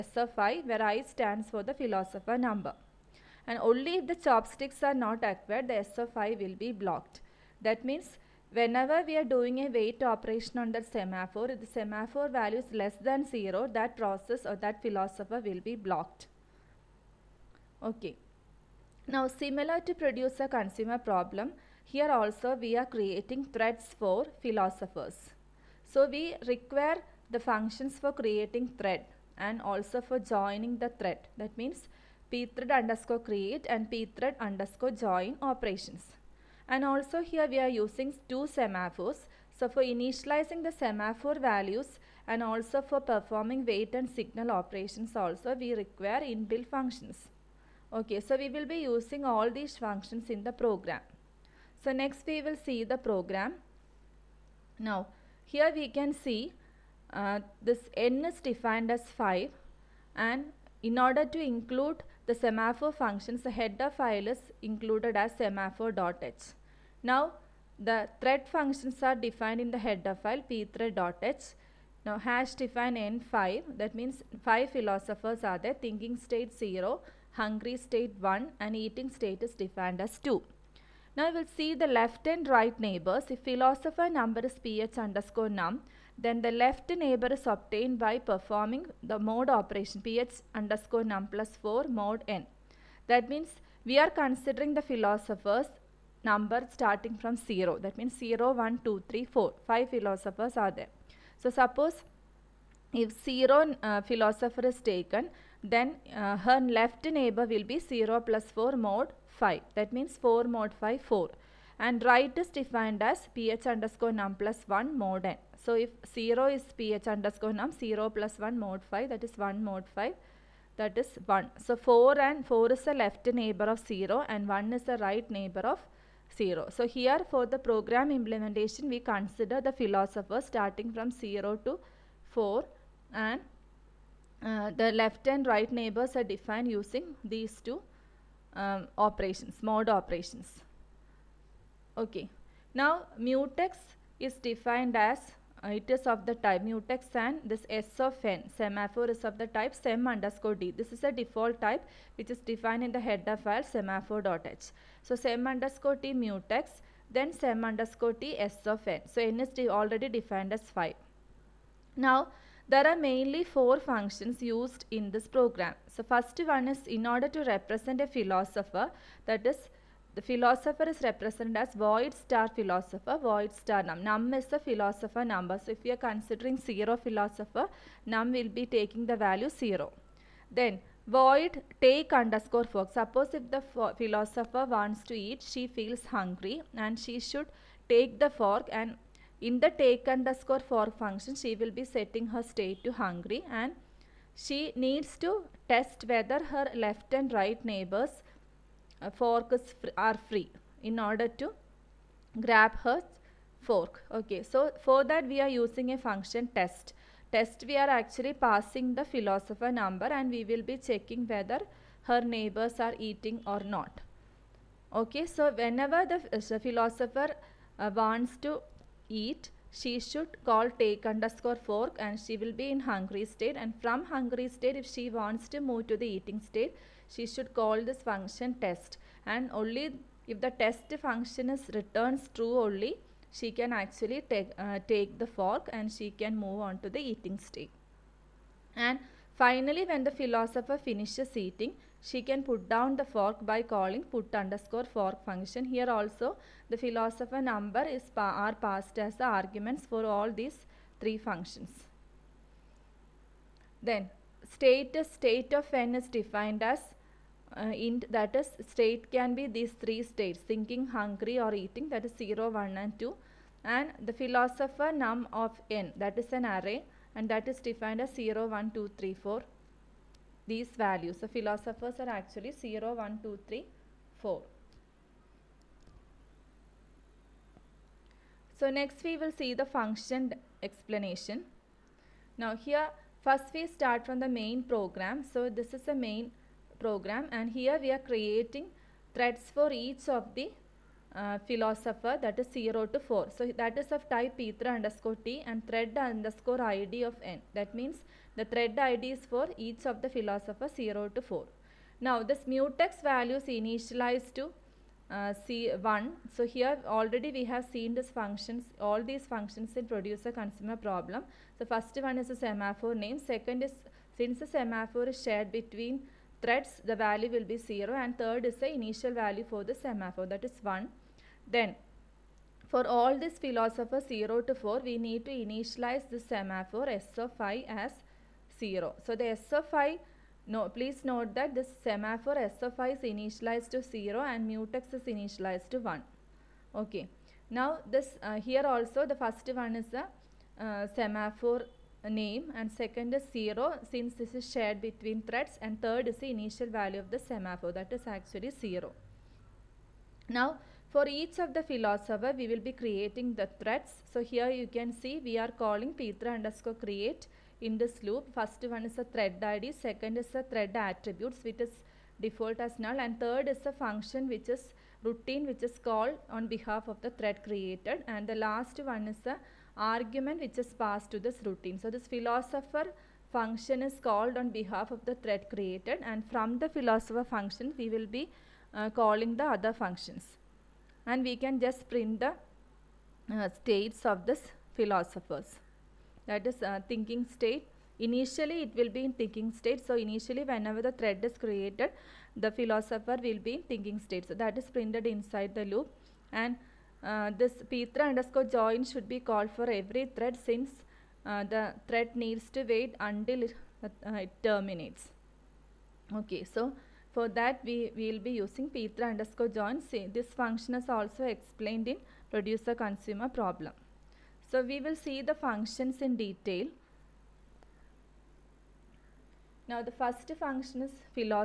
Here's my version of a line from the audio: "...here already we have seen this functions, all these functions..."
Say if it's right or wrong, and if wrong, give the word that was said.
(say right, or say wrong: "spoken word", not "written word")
right.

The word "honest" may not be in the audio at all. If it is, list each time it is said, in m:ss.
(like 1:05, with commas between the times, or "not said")
not said.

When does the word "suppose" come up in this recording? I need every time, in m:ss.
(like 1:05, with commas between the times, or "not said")
1:41, 3:02.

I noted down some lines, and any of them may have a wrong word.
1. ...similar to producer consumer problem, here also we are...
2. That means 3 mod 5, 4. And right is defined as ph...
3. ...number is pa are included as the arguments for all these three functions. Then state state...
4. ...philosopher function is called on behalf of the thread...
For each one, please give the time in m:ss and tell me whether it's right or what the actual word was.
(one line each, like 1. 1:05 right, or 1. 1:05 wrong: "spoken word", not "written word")
1. 0:19 right
2. 1:49 wrong: "4", not "3"
3. 4:07 wrong: "passed", not "included"
4. 6:12 right.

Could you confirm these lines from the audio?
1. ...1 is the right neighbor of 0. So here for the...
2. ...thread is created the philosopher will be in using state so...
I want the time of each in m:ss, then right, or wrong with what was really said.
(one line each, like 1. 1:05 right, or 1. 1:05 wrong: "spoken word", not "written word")
1. 2:04 right
2. 6:30 wrong: "thinking", not "using".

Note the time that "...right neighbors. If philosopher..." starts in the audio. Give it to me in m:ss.
1:22.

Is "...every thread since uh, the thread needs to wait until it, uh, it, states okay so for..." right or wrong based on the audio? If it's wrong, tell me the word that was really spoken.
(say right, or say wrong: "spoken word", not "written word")
wrong: "terminates", not "states".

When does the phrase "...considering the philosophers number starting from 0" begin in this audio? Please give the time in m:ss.
1:34.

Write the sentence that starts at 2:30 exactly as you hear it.
This is a default type which is defined in the header file semaphore.h.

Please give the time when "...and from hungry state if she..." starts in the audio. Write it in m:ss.
3:43.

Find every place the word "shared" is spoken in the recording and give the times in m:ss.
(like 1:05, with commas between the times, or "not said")
5:15, 5:44.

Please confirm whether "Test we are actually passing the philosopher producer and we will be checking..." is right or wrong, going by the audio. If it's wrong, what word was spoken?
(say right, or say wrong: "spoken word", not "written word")
wrong: "number", not "producer".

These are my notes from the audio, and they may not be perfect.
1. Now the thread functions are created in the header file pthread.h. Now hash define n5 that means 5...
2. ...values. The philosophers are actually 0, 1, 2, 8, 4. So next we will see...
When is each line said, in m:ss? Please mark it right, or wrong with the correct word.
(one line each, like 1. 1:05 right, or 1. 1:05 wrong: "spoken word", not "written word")
1. 1:07 wrong: "defined", not "created"
2. 4:30 wrong: "3", not "8".